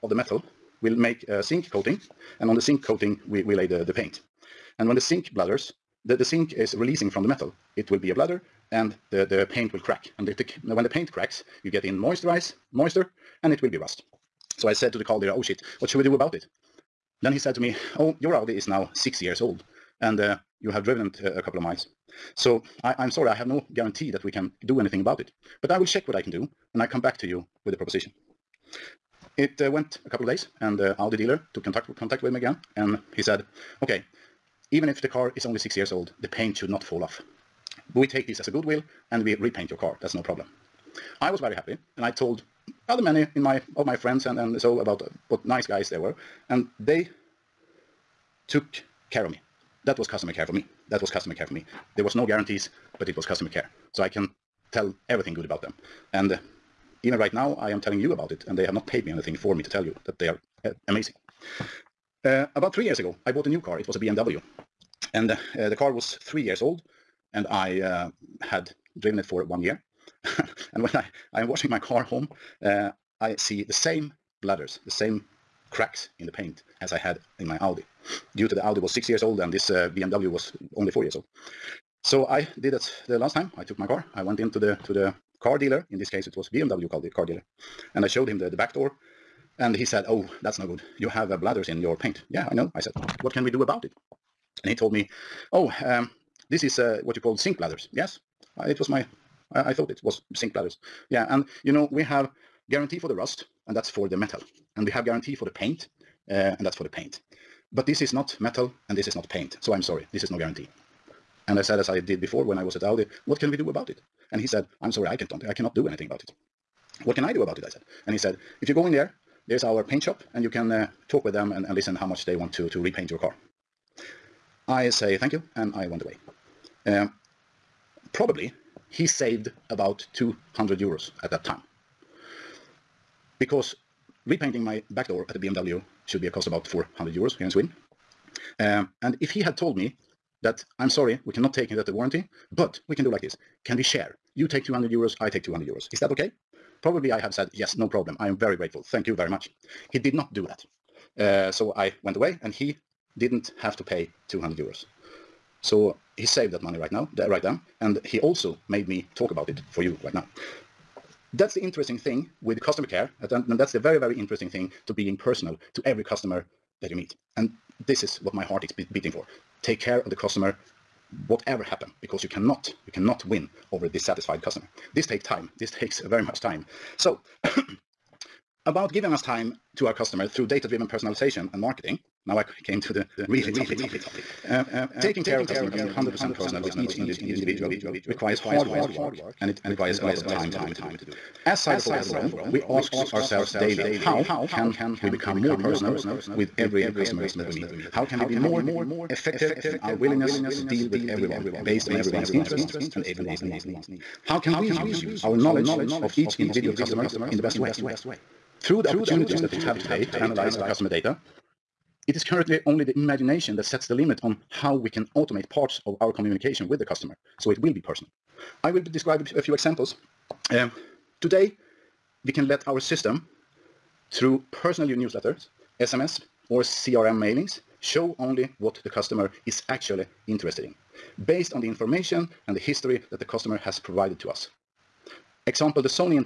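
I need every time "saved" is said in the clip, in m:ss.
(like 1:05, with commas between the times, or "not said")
2:09, 2:36.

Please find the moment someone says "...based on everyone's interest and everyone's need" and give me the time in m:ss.
3:21.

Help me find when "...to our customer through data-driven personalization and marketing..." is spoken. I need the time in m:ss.
2:59.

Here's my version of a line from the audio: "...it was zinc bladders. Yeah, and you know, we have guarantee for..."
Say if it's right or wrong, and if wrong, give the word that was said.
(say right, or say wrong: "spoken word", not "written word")
right.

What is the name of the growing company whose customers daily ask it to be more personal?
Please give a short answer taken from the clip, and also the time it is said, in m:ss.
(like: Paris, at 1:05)
Cyberphoto, at 3:11.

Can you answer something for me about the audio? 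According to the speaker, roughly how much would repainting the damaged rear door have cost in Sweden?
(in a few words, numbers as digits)
400 euros.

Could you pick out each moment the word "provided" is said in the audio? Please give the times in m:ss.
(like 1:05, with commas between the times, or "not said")
3:53.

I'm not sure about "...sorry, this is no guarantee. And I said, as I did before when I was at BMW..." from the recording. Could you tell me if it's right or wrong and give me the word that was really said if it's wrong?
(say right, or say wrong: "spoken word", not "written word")
wrong: "Audi", not "BMW".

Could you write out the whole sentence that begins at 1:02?
Uh, about three years ago, I bought a new car.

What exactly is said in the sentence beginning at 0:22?
So I, am sorry, I have no guarantee that we can do anything about it.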